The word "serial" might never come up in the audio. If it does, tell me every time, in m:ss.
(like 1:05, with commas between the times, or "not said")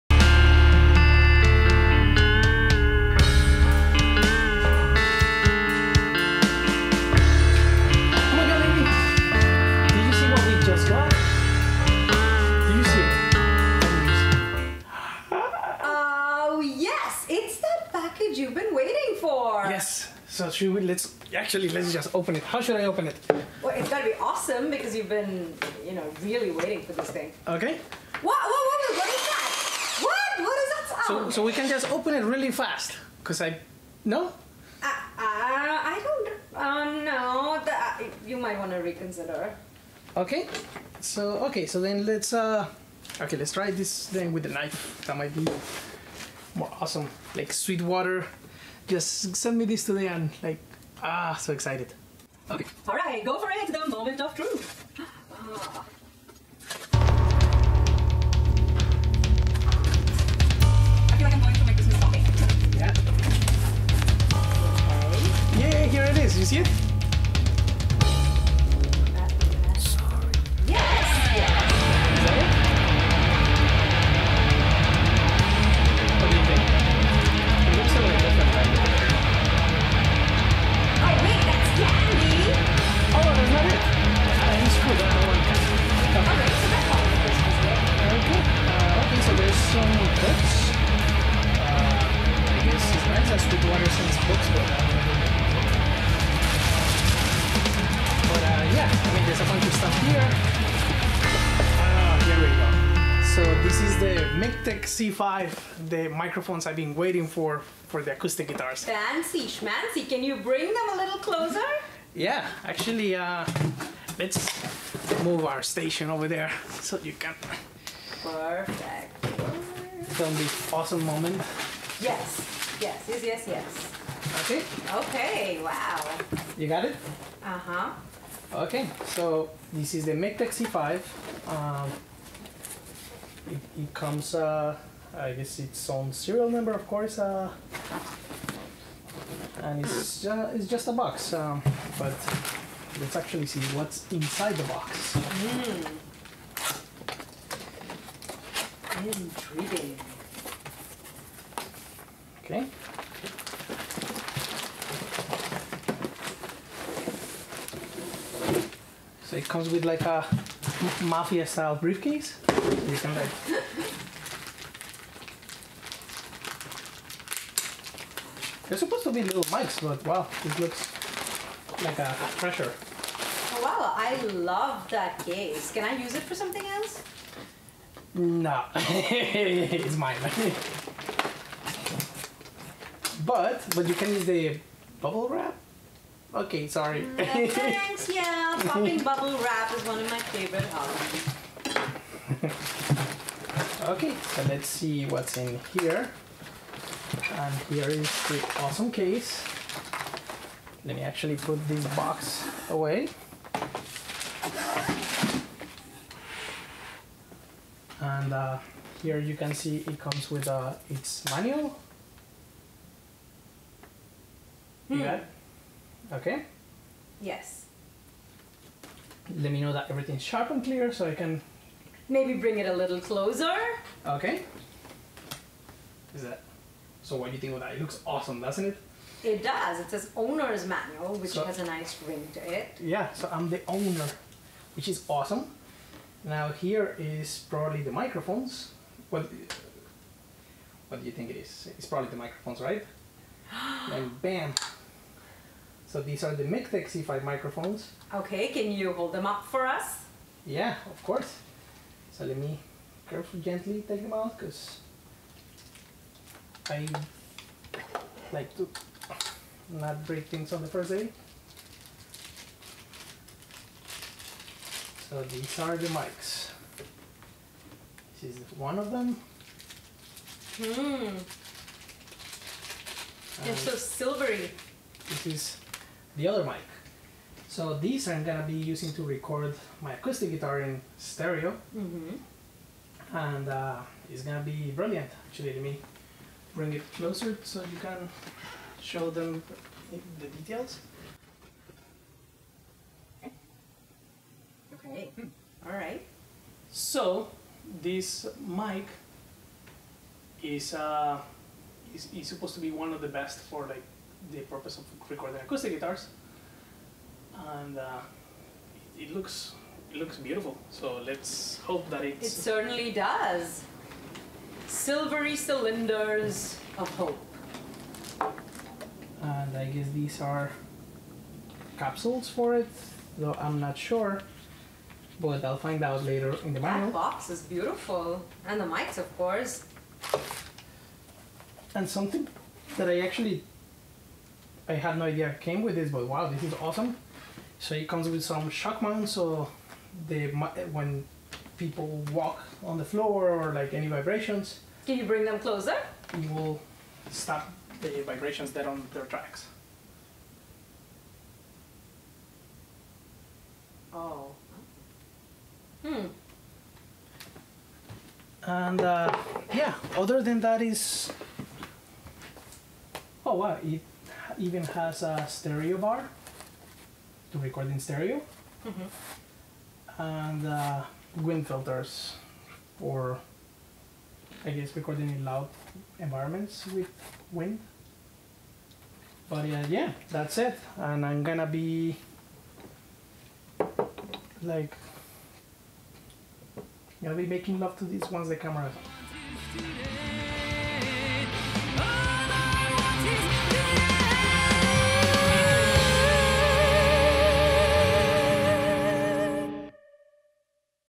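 2:16.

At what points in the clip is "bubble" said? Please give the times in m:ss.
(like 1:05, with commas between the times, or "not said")
3:04, 3:09.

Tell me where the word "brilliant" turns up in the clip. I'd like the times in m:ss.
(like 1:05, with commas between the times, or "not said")
4:44.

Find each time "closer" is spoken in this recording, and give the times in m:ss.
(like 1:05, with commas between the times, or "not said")
1:51, 3:42, 4:46, 5:45.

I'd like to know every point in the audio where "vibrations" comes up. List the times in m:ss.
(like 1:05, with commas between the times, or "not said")
5:43, 5:48.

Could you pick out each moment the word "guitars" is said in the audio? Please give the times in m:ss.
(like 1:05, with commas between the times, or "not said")
1:48, 4:40, 5:05.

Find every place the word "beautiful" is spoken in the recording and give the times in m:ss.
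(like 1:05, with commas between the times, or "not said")
5:10, 5:27.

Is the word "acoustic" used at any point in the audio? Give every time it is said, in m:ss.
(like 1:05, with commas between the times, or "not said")
1:48, 4:39, 5:05.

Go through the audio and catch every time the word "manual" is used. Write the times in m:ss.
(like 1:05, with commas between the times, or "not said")
3:31, 3:50, 5:26.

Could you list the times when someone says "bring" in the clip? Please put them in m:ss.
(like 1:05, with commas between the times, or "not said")
1:50, 3:42, 4:46, 5:45.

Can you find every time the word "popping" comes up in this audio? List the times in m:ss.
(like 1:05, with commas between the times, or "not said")
3:08.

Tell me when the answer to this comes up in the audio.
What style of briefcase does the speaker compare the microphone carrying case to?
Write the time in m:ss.
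2:41.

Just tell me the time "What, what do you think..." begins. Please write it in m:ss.
3:59.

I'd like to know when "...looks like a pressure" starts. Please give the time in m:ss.
2:50.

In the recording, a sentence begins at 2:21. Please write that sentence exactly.
Um, but let's actually see what's inside the box.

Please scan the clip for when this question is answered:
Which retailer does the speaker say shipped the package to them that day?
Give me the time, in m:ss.
0:47.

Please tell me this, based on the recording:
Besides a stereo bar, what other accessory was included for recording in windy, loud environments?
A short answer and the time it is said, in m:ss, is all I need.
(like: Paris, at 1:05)
Wind filters, at 6:11.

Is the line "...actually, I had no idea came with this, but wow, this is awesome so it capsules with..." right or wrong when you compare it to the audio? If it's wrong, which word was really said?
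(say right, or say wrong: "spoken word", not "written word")
wrong: "comes", not "capsules".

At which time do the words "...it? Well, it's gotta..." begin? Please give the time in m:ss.
0:23.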